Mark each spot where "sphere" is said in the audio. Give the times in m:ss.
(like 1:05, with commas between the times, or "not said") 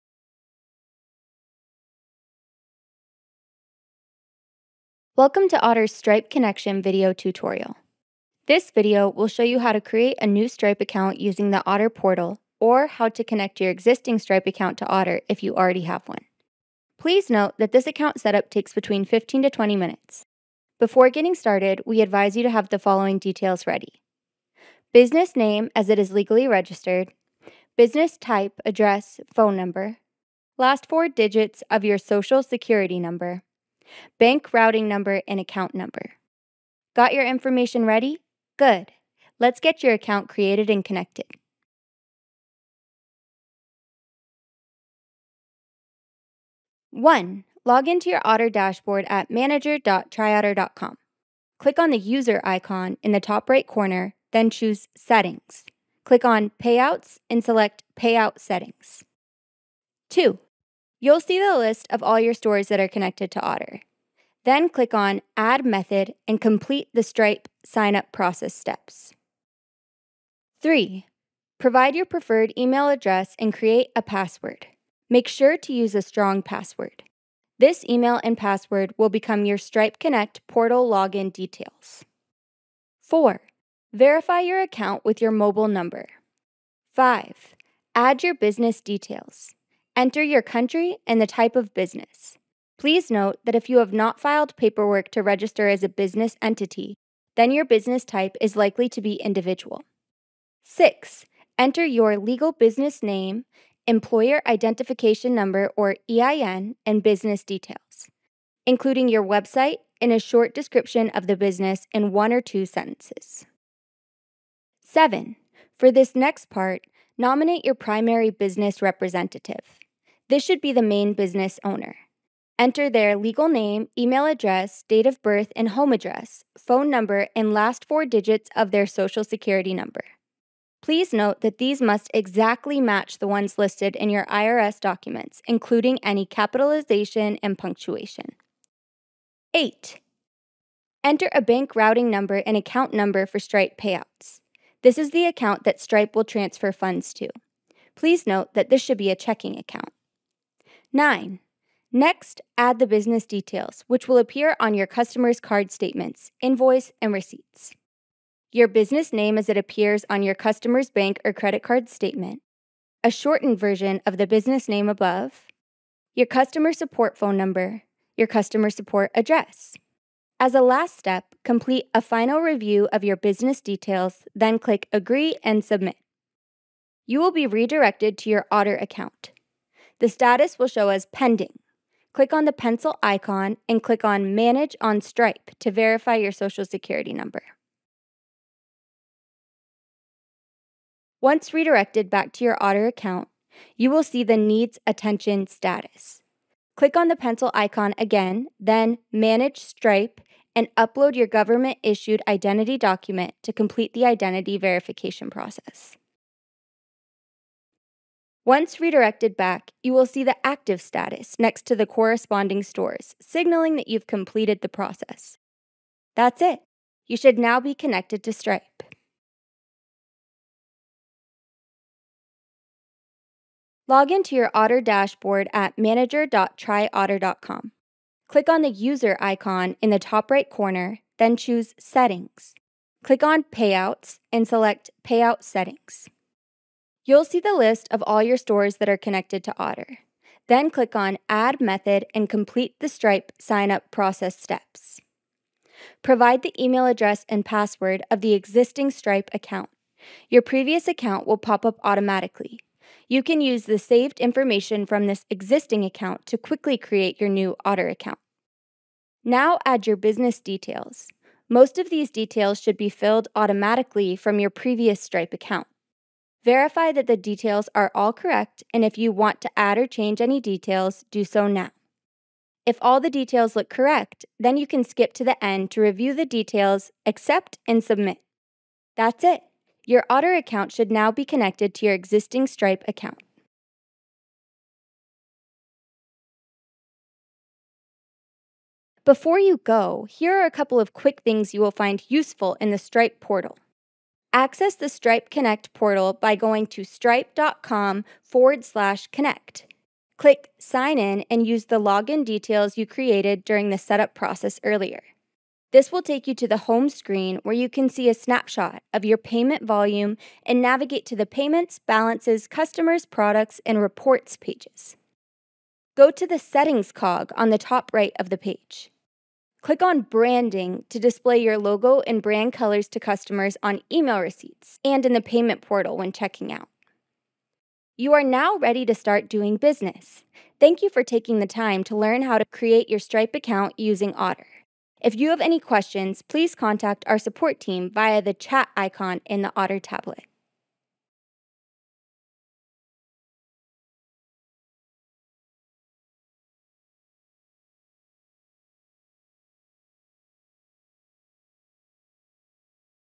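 not said.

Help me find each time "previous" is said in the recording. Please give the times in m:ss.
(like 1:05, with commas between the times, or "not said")
4:10, 4:24.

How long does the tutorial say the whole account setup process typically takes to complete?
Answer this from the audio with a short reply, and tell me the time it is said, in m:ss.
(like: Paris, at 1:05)
15 to 20 minutes, at 0:19.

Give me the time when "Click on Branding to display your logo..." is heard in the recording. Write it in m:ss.
5:19.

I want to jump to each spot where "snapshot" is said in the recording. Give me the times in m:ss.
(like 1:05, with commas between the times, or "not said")
5:08.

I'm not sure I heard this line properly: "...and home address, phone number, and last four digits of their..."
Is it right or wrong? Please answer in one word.
right.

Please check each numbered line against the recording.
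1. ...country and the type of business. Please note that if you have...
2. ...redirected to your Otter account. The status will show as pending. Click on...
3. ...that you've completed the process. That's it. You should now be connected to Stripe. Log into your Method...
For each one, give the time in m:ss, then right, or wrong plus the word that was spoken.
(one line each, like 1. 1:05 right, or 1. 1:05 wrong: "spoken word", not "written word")
1. 1:30 right
2. 2:57 right
3. 3:33 wrong: "Otter", not "Method".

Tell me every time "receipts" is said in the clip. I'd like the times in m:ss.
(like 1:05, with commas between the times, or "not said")
2:37, 5:24.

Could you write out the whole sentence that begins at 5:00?
Click Sign In and use the login details you created during the setup process earlier.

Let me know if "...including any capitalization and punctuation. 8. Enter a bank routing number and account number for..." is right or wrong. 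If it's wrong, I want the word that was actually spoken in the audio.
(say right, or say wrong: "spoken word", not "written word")
right.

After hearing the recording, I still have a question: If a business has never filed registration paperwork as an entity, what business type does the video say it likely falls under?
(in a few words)
Individual.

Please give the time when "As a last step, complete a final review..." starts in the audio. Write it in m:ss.
2:50.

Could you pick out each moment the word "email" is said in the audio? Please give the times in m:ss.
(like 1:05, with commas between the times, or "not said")
1:12, 1:17, 2:03, 4:06, 5:23.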